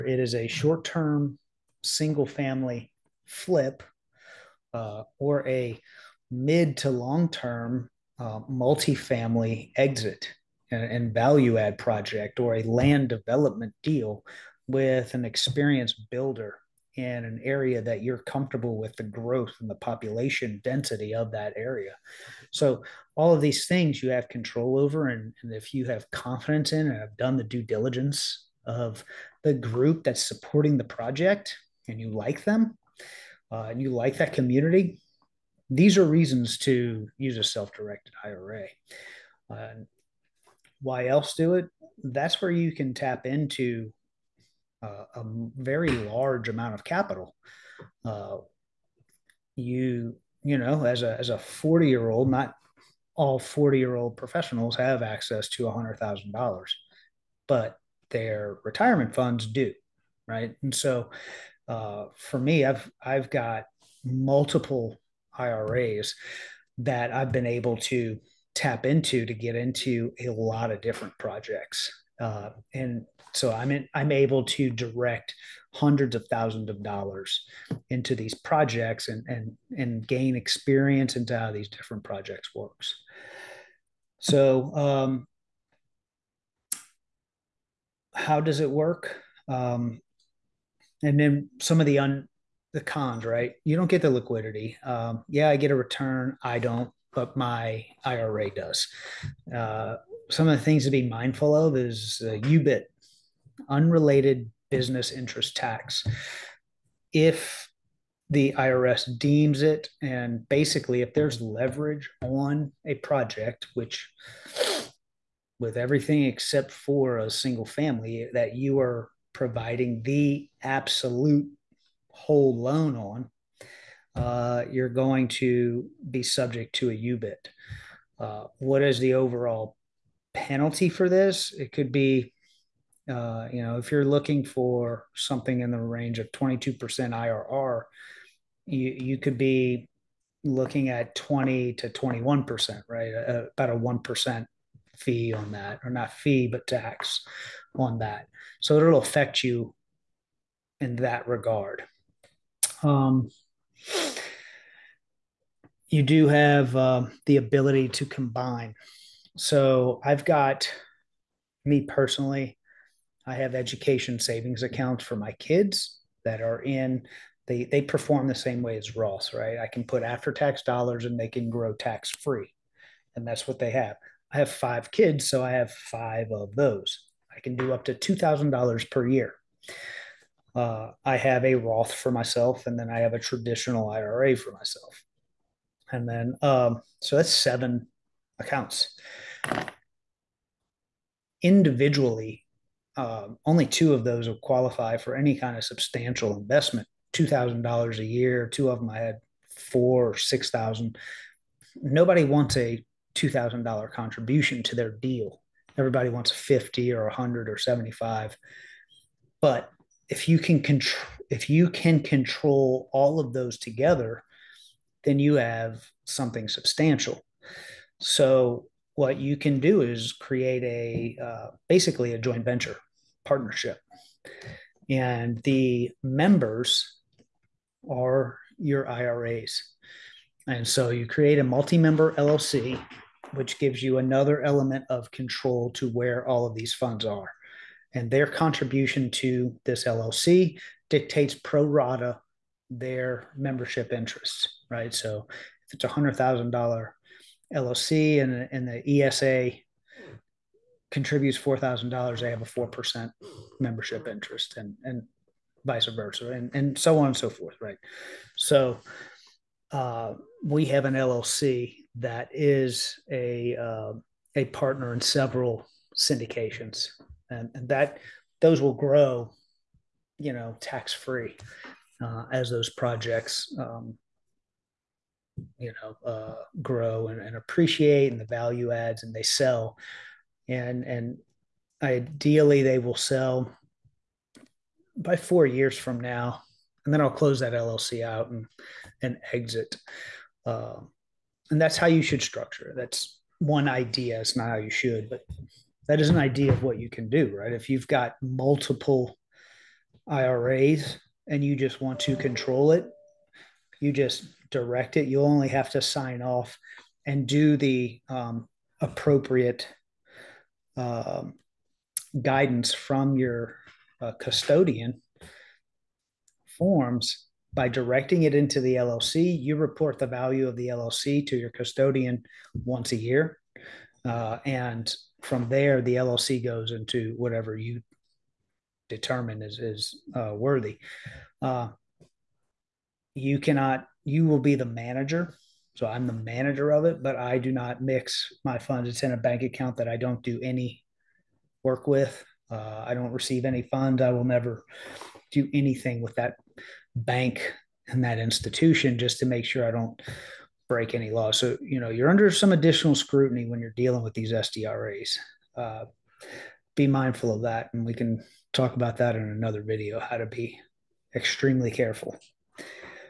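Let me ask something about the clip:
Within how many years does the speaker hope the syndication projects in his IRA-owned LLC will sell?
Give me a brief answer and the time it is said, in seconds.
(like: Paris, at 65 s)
4 years, at 285 s.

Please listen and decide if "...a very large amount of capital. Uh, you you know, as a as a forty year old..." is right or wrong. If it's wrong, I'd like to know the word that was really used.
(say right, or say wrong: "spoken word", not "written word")
right.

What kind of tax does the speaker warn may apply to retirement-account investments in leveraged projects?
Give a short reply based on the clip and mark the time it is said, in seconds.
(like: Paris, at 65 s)
unrelated business interest tax, at 103 s.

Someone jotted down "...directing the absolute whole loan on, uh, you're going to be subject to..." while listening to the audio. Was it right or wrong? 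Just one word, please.
wrong.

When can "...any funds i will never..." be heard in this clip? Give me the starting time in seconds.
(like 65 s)
343 s.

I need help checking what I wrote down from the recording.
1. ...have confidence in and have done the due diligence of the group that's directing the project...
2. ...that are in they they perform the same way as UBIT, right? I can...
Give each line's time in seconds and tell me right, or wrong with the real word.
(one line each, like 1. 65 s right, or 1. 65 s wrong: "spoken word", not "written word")
1. 25 s wrong: "supporting", not "directing"
2. 166 s wrong: "Roths", not "UBIT".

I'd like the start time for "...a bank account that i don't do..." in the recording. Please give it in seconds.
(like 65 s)
339 s.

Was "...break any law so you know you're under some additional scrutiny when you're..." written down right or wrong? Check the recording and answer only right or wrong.
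right.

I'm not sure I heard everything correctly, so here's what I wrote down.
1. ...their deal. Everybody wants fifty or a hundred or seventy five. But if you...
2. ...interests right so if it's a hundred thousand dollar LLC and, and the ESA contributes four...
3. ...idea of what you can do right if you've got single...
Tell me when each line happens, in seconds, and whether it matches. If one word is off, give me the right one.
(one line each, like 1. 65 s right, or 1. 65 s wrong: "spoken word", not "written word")
1. 204 s right
2. 243 s right
3. 296 s wrong: "multiple", not "single".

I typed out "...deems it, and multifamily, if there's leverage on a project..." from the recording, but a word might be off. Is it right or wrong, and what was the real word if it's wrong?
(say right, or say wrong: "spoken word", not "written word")
wrong: "basically", not "multifamily".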